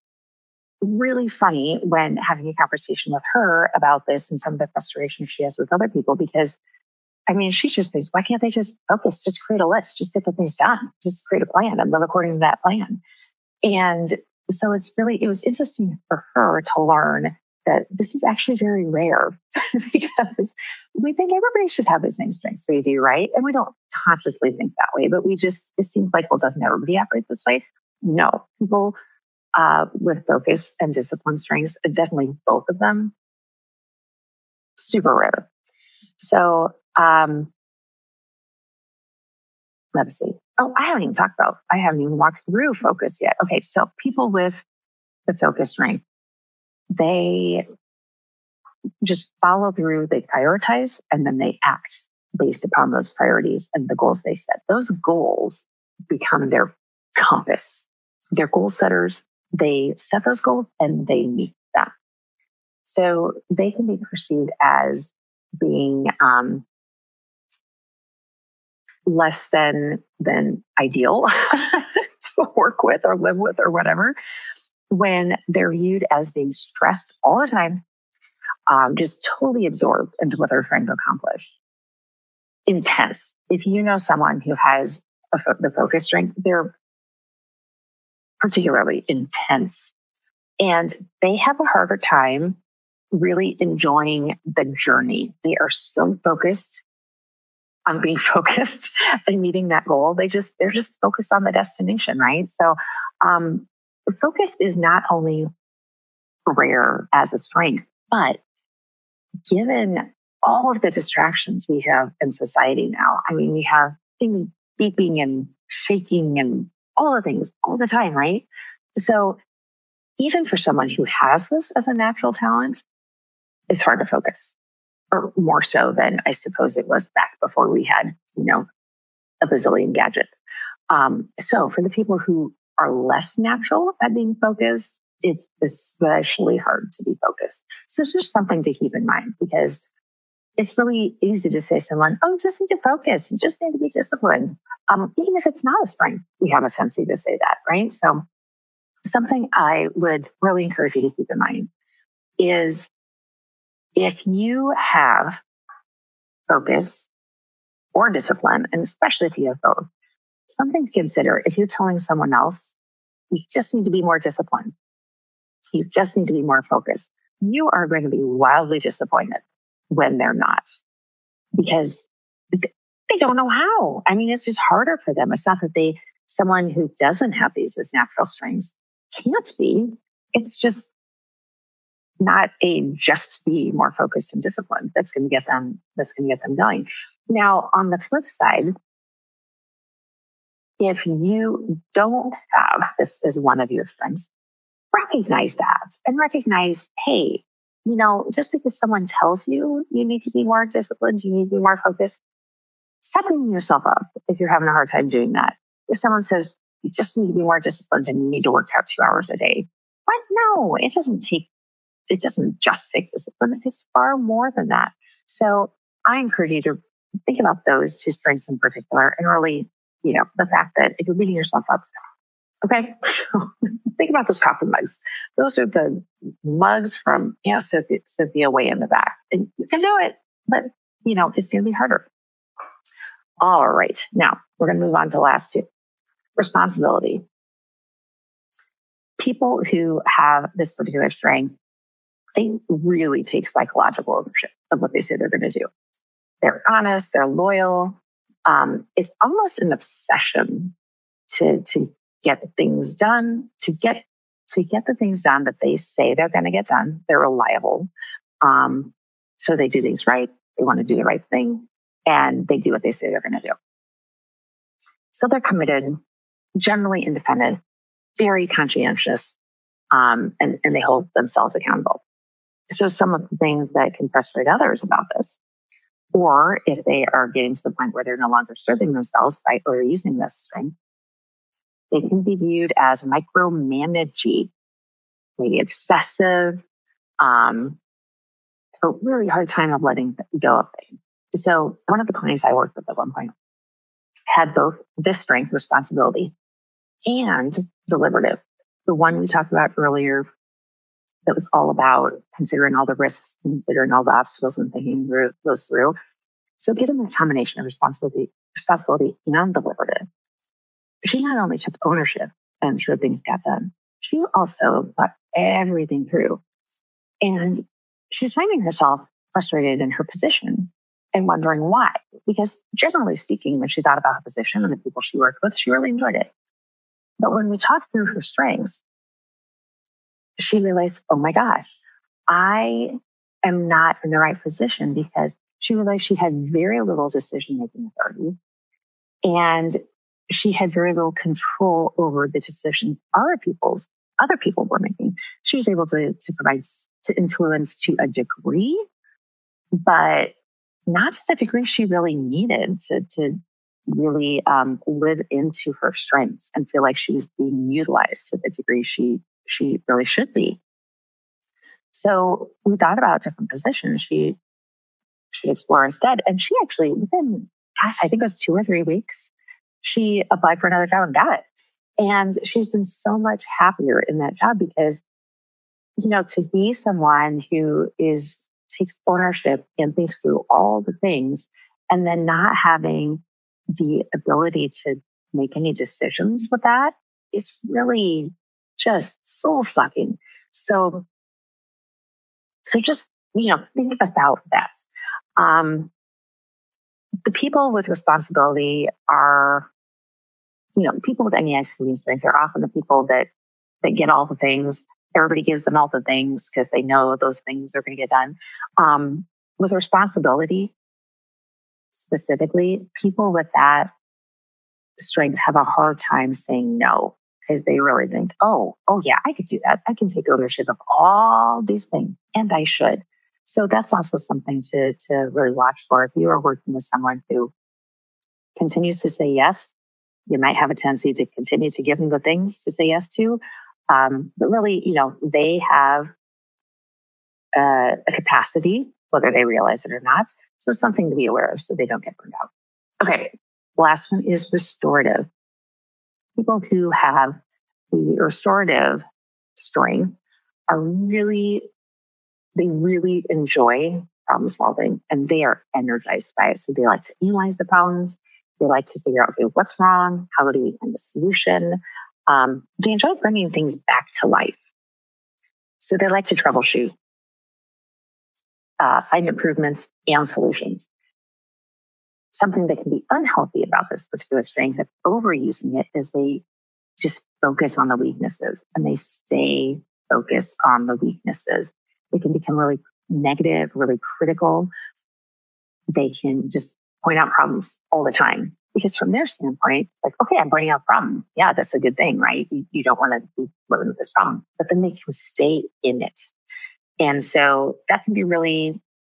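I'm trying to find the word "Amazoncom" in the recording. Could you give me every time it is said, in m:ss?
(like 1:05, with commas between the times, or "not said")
not said.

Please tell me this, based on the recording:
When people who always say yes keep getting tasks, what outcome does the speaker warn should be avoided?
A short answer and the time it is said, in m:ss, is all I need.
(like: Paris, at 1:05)
burned out, at 7:22.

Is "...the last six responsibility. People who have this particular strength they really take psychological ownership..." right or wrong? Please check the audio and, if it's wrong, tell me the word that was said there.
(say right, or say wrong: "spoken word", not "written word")
wrong: "two", not "six".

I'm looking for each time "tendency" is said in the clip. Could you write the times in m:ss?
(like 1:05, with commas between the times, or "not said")
2:26, 7:10.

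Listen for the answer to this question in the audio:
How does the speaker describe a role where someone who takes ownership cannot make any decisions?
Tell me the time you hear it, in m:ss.
6:29.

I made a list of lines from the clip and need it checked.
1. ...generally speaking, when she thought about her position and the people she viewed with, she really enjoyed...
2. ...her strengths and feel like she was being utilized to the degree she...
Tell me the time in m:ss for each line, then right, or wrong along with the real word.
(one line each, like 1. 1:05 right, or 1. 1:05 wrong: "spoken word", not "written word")
1. 5:22 wrong: "worked", not "viewed"
2. 5:55 right.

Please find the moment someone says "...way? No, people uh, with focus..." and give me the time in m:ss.
0:27.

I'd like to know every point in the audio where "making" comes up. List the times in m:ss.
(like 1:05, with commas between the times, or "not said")
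5:37, 5:44.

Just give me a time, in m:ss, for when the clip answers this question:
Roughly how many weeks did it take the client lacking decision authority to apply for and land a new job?
6:08.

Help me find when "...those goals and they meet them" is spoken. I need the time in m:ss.
1:00.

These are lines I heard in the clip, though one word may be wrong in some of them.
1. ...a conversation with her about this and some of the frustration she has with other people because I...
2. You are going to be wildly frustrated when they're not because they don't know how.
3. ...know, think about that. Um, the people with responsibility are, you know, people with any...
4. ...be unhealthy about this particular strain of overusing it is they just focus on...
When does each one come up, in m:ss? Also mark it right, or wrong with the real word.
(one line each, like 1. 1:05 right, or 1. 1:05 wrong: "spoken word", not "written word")
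1. 0:02 right
2. 2:47 wrong: "disappointed", not "frustrated"
3. 6:33 right
4. 7:52 right.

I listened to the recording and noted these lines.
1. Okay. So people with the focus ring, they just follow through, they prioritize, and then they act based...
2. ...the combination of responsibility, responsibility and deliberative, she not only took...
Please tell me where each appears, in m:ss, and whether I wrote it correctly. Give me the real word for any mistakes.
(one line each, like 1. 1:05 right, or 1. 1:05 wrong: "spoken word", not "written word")
1. 0:43 right
2. 5:06 right.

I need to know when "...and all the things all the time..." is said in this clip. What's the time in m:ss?
1:56.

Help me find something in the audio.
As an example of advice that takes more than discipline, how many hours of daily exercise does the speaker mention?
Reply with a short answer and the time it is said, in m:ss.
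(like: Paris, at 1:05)
2 hours, at 3:28.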